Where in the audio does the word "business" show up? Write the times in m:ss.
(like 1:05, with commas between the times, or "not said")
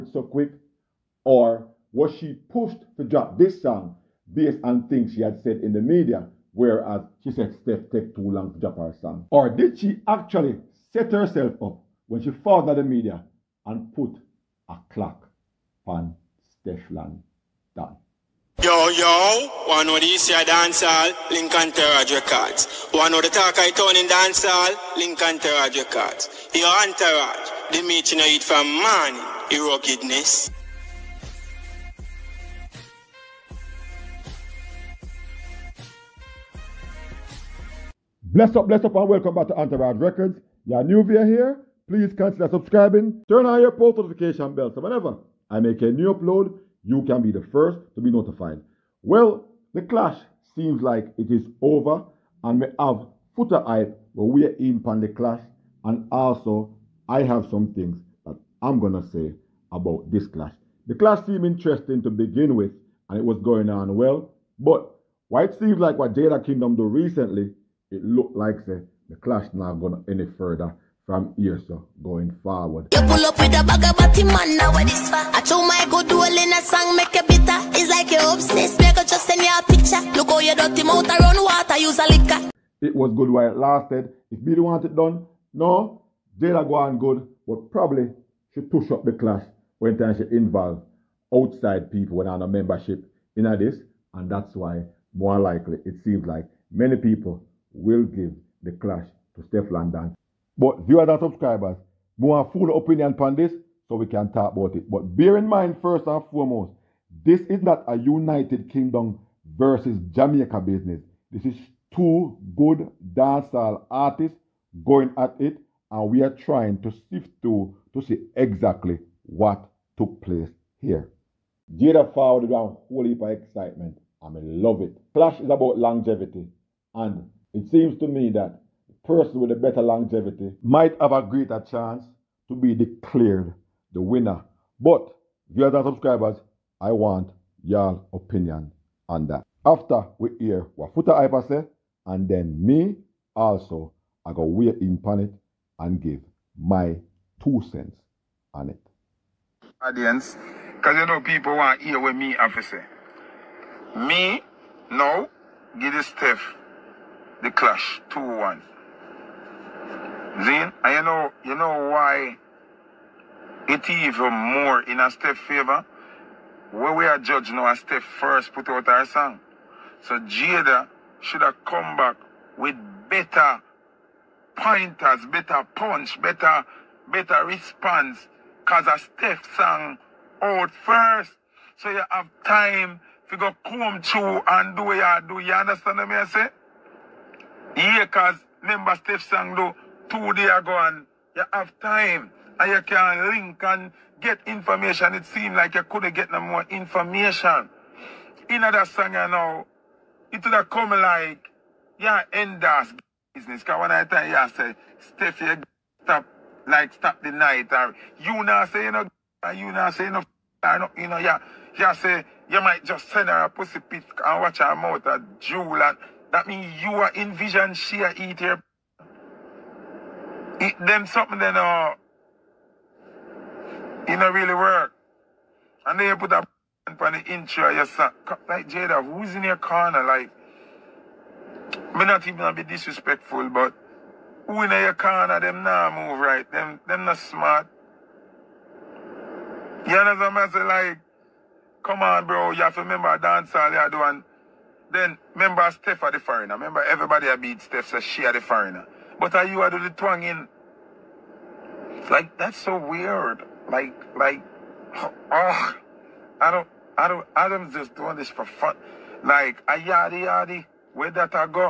1:50, 3:23.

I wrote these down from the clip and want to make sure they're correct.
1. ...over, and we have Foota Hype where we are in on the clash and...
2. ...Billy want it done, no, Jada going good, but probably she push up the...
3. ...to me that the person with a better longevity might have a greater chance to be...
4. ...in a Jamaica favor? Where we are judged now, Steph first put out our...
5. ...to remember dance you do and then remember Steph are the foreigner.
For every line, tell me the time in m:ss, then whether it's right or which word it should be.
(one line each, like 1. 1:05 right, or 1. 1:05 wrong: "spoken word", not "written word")
1. 0:51 right
2. 1:24 right
3. 2:07 right
4. 2:44 wrong: "Steph", not "Jamaica"
5. 4:02 right.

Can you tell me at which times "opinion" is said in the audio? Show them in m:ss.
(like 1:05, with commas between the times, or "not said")
1:42, 2:18.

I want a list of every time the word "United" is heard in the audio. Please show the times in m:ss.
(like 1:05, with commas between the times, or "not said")
1:47.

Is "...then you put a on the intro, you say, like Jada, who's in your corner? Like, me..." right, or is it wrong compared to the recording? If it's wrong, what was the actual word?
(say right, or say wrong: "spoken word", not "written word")
right.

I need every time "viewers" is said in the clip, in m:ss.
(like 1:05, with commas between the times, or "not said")
1:40, 2:15.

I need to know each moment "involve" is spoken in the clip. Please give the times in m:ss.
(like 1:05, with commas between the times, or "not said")
1:30.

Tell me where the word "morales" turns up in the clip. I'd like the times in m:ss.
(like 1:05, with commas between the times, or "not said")
not said.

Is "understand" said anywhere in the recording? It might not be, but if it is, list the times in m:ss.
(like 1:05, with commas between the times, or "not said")
3:05, 3:59.